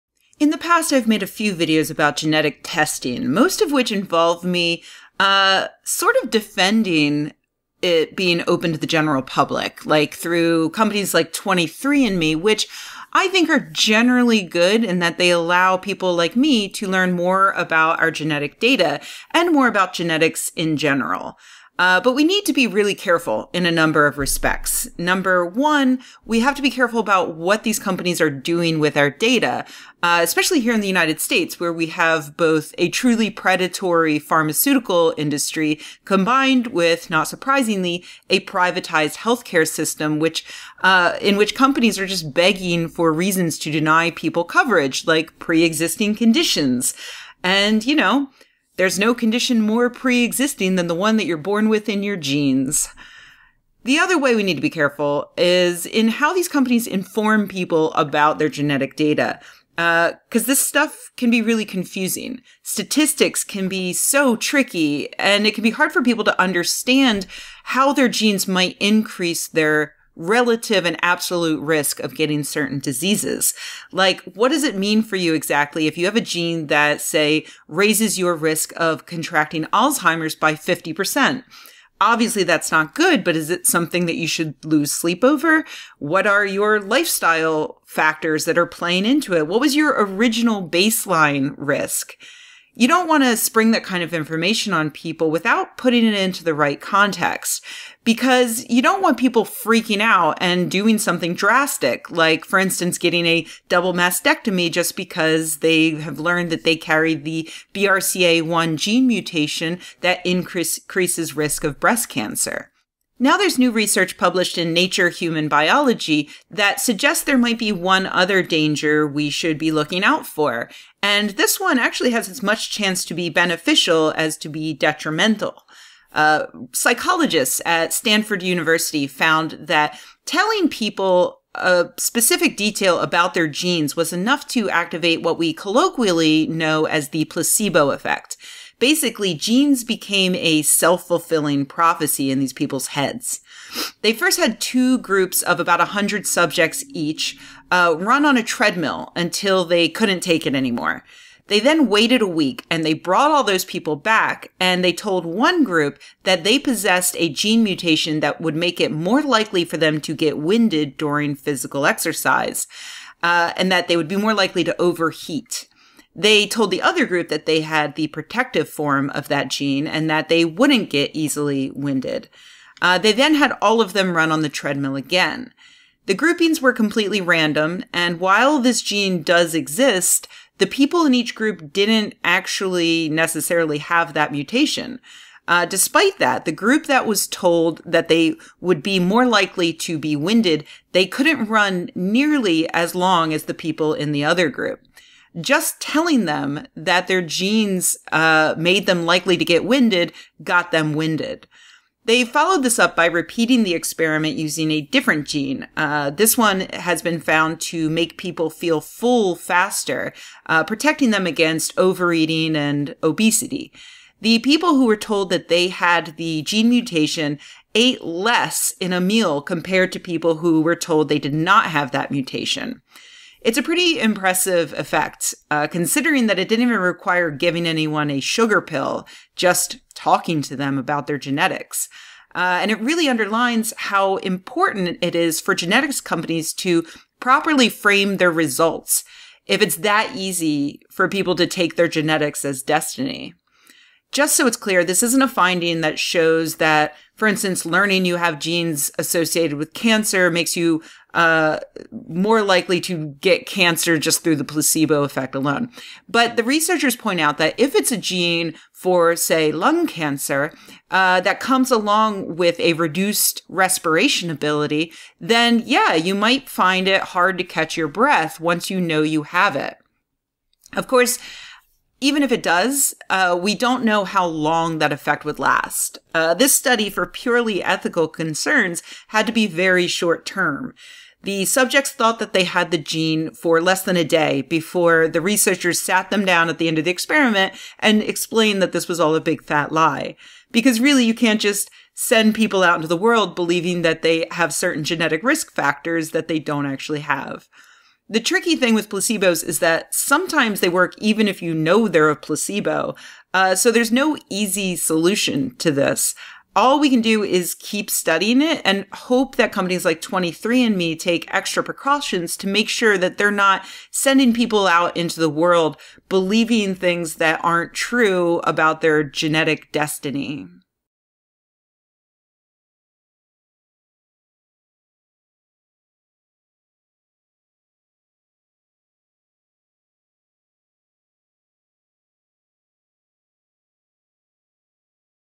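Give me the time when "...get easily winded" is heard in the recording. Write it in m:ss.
2:50.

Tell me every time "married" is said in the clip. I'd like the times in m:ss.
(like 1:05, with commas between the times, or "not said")
not said.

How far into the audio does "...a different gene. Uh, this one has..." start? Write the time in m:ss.
3:24.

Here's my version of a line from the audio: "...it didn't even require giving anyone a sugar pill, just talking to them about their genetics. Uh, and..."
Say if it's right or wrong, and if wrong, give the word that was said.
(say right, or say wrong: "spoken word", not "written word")
right.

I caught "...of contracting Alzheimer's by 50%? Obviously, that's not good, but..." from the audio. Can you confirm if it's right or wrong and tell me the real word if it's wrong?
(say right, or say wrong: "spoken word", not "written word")
right.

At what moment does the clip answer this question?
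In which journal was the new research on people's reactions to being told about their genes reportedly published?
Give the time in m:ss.
1:54.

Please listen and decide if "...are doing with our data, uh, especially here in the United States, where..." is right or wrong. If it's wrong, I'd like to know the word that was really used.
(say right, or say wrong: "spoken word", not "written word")
right.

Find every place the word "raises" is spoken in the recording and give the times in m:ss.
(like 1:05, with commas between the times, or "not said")
1:17.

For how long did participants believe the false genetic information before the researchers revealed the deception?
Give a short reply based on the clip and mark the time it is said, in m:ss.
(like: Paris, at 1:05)
less than a day, at 4:43.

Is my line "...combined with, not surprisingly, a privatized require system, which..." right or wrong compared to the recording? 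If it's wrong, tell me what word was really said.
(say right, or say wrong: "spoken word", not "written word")
wrong: "healthcare", not "require".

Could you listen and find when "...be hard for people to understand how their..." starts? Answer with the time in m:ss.
1:05.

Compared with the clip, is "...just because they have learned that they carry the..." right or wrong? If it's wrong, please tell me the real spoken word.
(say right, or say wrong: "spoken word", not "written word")
right.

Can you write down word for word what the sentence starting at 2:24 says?
They first had two groups of about 100 subjects each uh, run on a treadmill until they couldn't take it anymore.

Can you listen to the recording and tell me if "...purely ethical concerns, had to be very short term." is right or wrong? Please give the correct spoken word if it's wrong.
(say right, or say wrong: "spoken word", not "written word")
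right.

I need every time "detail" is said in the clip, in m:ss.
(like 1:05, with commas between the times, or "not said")
2:12.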